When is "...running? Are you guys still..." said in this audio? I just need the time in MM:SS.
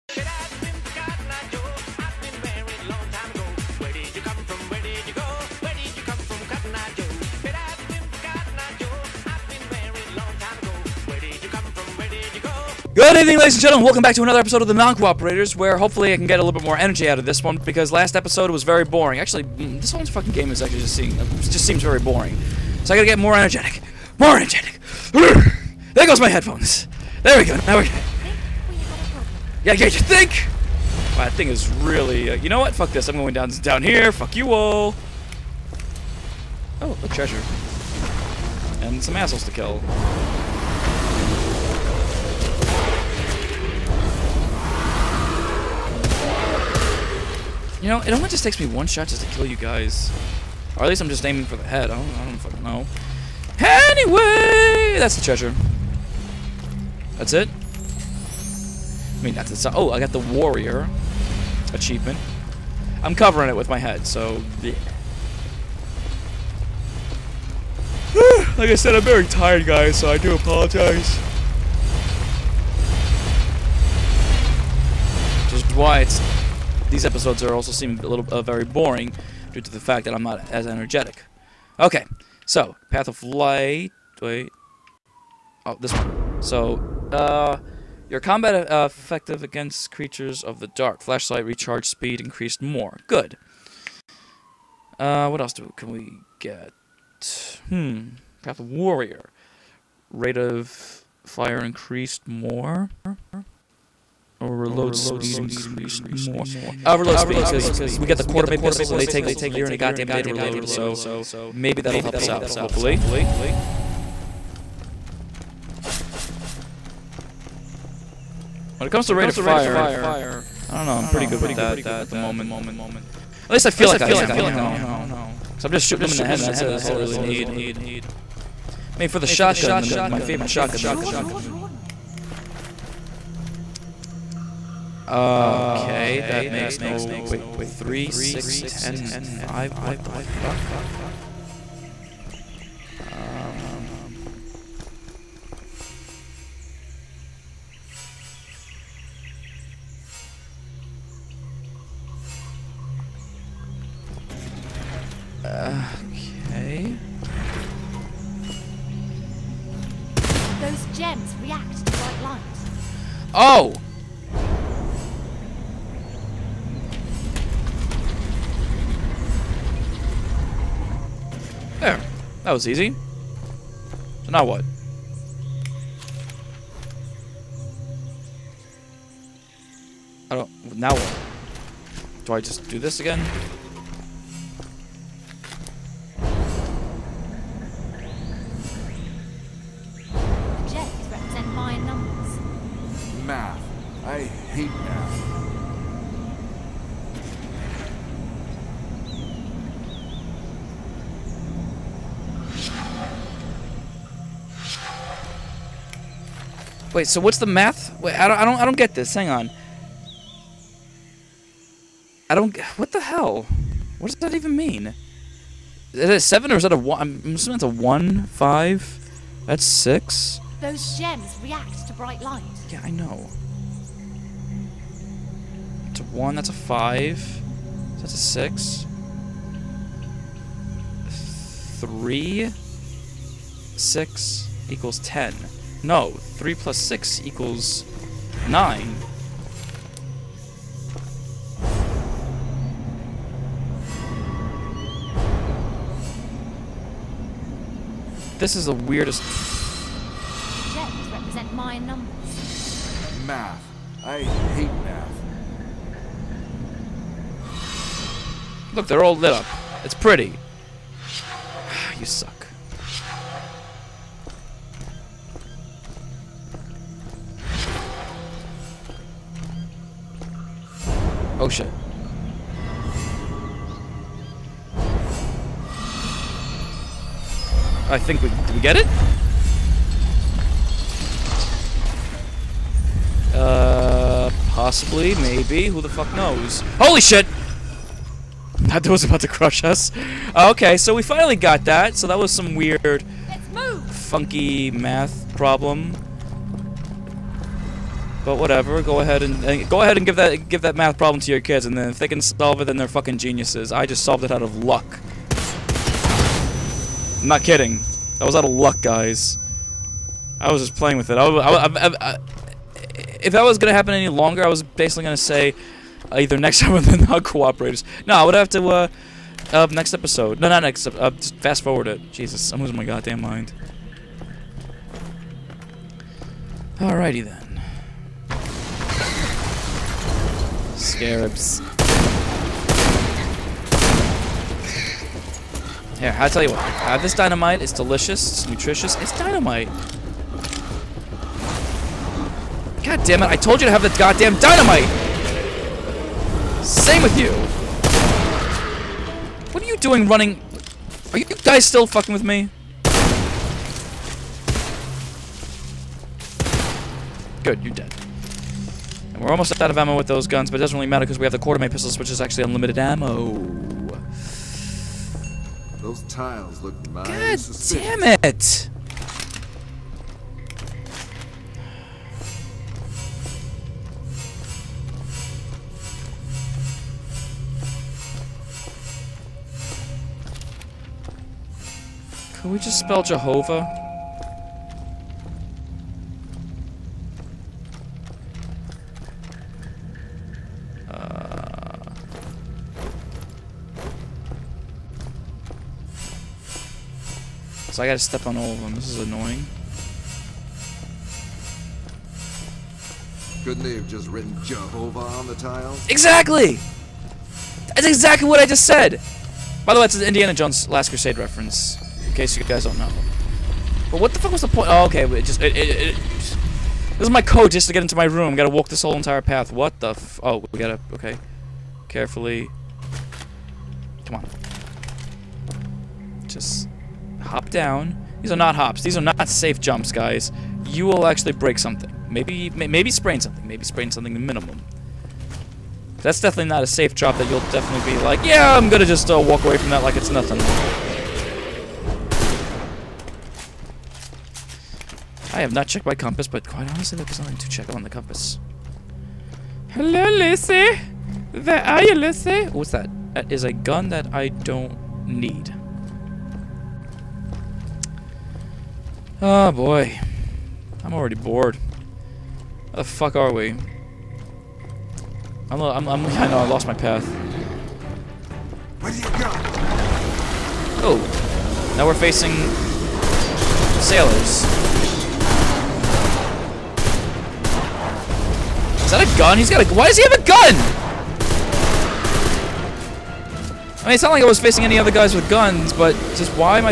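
05:50.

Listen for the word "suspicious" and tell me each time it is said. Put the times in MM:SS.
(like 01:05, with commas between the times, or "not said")
06:07.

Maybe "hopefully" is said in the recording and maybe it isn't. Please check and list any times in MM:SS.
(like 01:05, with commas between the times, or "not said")
00:15, 01:52.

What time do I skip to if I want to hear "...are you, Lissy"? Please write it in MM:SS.
07:31.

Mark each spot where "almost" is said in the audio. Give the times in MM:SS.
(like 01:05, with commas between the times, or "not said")
05:59.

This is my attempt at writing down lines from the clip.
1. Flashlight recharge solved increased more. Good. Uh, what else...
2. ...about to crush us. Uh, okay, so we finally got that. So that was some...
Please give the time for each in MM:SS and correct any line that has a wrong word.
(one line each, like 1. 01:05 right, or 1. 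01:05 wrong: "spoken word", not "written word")
1. 01:31 wrong: "speed", not "solved"
2. 04:49 right.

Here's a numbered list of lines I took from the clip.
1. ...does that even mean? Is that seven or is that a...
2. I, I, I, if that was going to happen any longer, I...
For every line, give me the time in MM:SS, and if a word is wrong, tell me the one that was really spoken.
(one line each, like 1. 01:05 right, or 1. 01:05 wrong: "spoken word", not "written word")
1. 03:34 right
2. 05:11 right.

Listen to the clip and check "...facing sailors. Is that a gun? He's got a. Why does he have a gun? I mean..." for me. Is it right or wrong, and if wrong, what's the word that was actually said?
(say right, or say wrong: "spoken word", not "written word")
right.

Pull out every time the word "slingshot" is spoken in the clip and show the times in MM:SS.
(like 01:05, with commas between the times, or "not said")
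not said.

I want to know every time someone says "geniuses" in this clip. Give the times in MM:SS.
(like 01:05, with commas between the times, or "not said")
05:03.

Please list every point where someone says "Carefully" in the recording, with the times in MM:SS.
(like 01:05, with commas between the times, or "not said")
07:01.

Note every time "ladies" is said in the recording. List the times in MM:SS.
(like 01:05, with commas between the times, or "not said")
00:13.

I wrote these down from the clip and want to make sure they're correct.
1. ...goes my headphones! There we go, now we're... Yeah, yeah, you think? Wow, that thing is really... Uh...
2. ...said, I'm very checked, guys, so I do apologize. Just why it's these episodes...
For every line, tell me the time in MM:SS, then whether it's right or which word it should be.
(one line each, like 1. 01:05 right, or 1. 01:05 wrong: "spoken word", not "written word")
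1. 00:26 right
2. 01:08 wrong: "tired", not "checked".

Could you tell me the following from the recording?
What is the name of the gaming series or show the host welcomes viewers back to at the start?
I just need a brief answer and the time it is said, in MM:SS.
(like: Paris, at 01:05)
The Non-Cooperators, at 00:14.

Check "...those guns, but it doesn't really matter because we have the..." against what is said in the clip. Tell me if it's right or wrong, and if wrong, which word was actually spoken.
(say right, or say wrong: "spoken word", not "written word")
right.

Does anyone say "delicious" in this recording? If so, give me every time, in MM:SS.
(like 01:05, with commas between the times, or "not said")
05:37.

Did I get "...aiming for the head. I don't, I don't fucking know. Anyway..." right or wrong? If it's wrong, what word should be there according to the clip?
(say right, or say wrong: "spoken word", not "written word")
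right.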